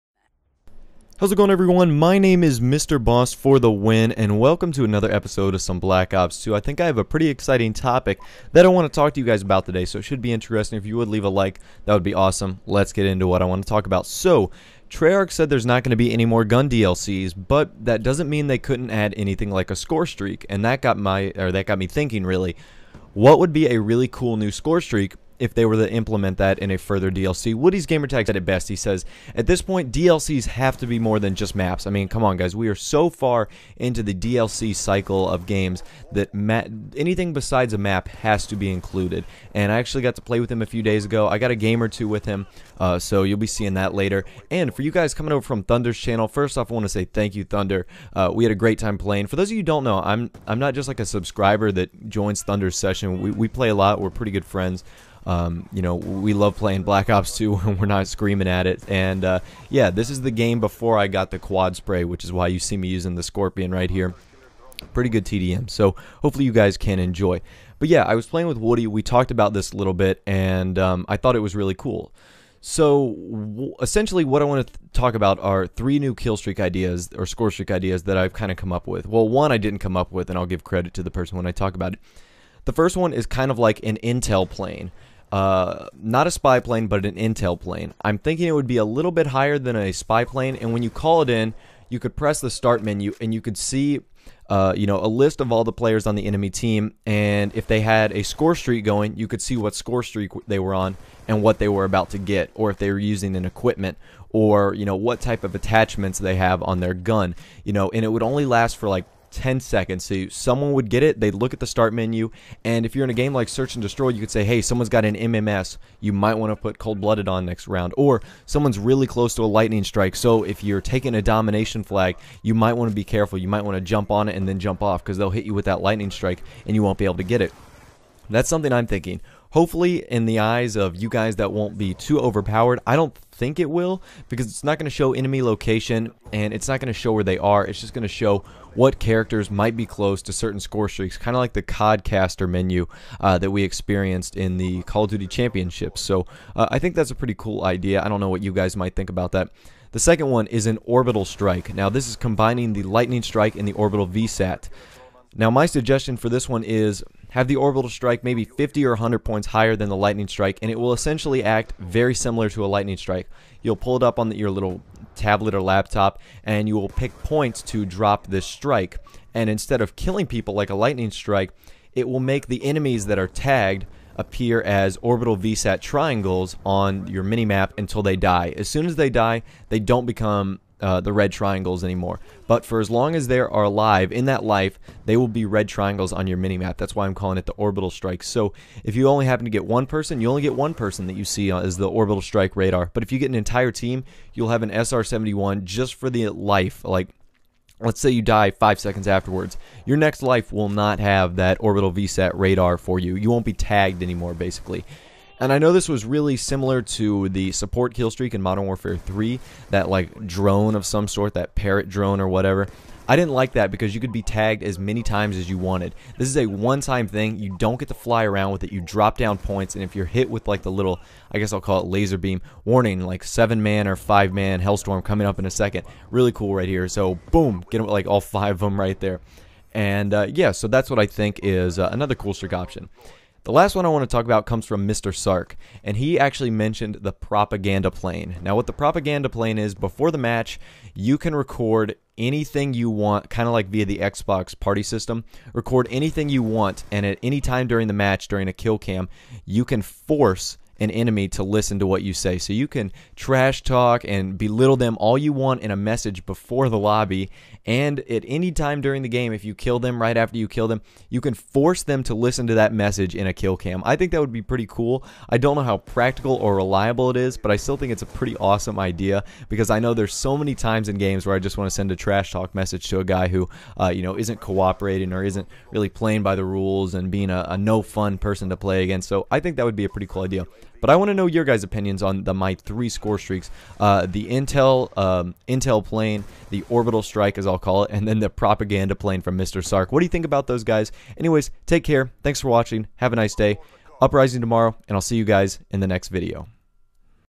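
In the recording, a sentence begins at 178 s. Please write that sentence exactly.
As soon as they die, they don't become uh, the red triangles anymore.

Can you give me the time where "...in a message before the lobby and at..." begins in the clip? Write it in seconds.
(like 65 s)
255 s.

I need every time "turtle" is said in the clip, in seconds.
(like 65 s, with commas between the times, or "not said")
not said.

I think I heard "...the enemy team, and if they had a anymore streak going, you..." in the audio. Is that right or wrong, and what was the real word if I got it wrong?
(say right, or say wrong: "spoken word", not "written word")
wrong: "score", not "anymore".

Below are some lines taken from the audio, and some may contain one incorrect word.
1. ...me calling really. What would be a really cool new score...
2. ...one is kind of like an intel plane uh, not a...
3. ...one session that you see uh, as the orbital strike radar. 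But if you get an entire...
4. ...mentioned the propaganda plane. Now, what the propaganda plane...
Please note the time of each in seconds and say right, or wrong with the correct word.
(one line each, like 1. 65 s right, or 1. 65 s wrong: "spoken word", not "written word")
1. 21 s wrong: "thinking", not "calling"
2. 82 s right
3. 190 s wrong: "person", not "session"
4. 236 s right.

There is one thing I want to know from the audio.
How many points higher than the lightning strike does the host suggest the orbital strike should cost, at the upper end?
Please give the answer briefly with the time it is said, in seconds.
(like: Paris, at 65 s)
100, at 158 s.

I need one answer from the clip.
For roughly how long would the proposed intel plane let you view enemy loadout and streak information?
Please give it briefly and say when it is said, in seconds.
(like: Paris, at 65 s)
10 seconds, at 109 s.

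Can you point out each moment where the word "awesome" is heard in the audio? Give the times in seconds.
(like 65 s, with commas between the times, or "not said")
12 s, 268 s.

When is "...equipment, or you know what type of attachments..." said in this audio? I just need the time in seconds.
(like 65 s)
103 s.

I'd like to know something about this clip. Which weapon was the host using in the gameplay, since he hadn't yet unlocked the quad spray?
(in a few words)
Skorpion.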